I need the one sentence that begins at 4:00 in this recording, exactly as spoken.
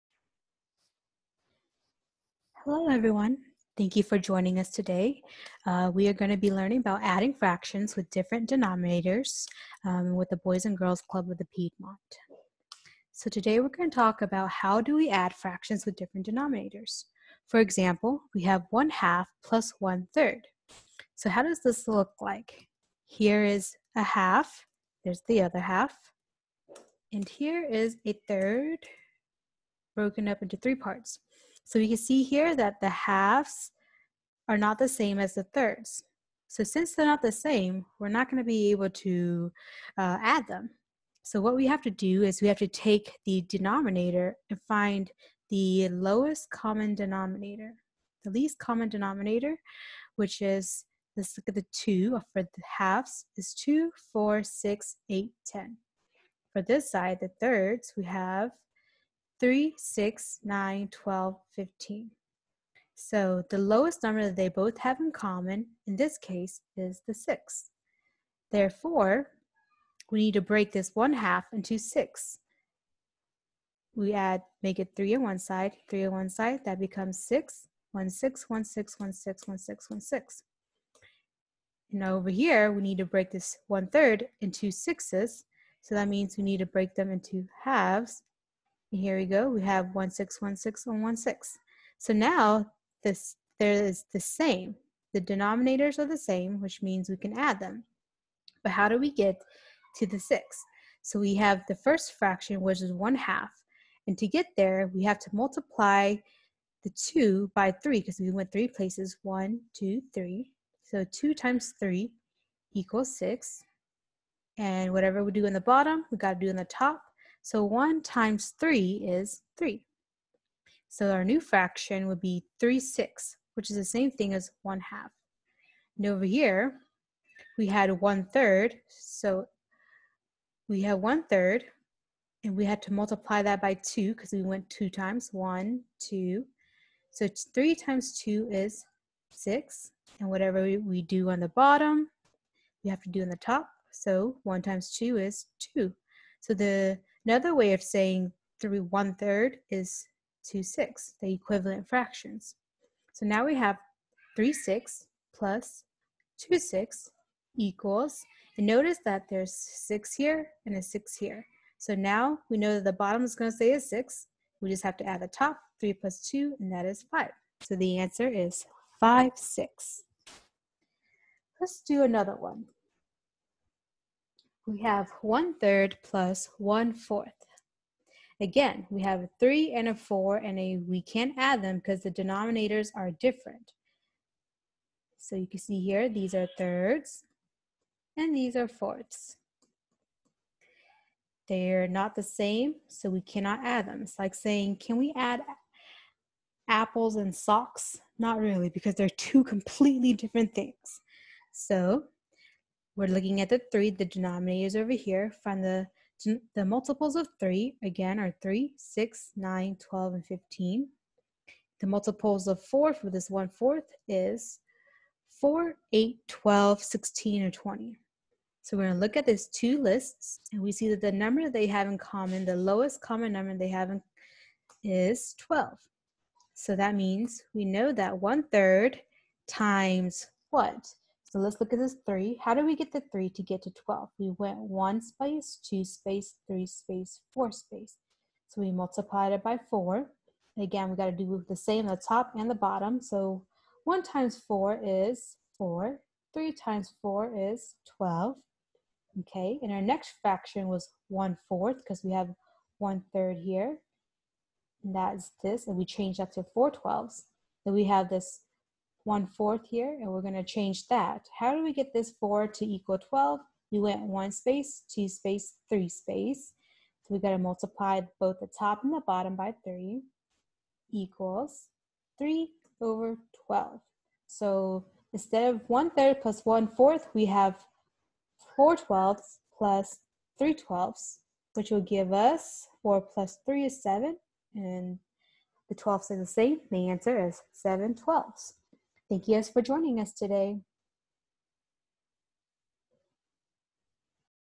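And again, we gotta do the same, the top and the bottom.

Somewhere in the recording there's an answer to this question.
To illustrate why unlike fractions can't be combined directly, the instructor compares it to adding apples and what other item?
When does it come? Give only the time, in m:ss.
3:17.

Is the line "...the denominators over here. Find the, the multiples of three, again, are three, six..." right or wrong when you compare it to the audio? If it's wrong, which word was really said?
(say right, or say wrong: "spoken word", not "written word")
right.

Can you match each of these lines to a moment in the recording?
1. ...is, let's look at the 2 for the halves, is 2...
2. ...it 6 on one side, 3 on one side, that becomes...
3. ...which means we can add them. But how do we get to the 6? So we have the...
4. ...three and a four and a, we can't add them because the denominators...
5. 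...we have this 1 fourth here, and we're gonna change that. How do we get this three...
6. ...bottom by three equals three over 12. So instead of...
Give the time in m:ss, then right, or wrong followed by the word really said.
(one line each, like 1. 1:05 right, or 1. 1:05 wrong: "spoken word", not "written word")
1. 0:50 right
2. 1:14 wrong: "3", not "6"
3. 1:36 right
4. 2:59 right
5. 4:17 wrong: "four", not "three"
6. 4:29 right.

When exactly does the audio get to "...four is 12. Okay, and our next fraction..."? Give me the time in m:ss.
4:07.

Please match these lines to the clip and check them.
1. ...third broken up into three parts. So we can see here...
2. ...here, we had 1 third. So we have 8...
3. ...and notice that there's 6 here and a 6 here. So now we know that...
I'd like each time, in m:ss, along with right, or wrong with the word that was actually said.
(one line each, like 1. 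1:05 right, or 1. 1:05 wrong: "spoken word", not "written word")
1. 0:28 right
2. 2:06 wrong: "1", not "8"
3. 2:38 right.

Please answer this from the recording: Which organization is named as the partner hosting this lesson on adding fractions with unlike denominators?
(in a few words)
Boys and Girls Club of the Piedmont.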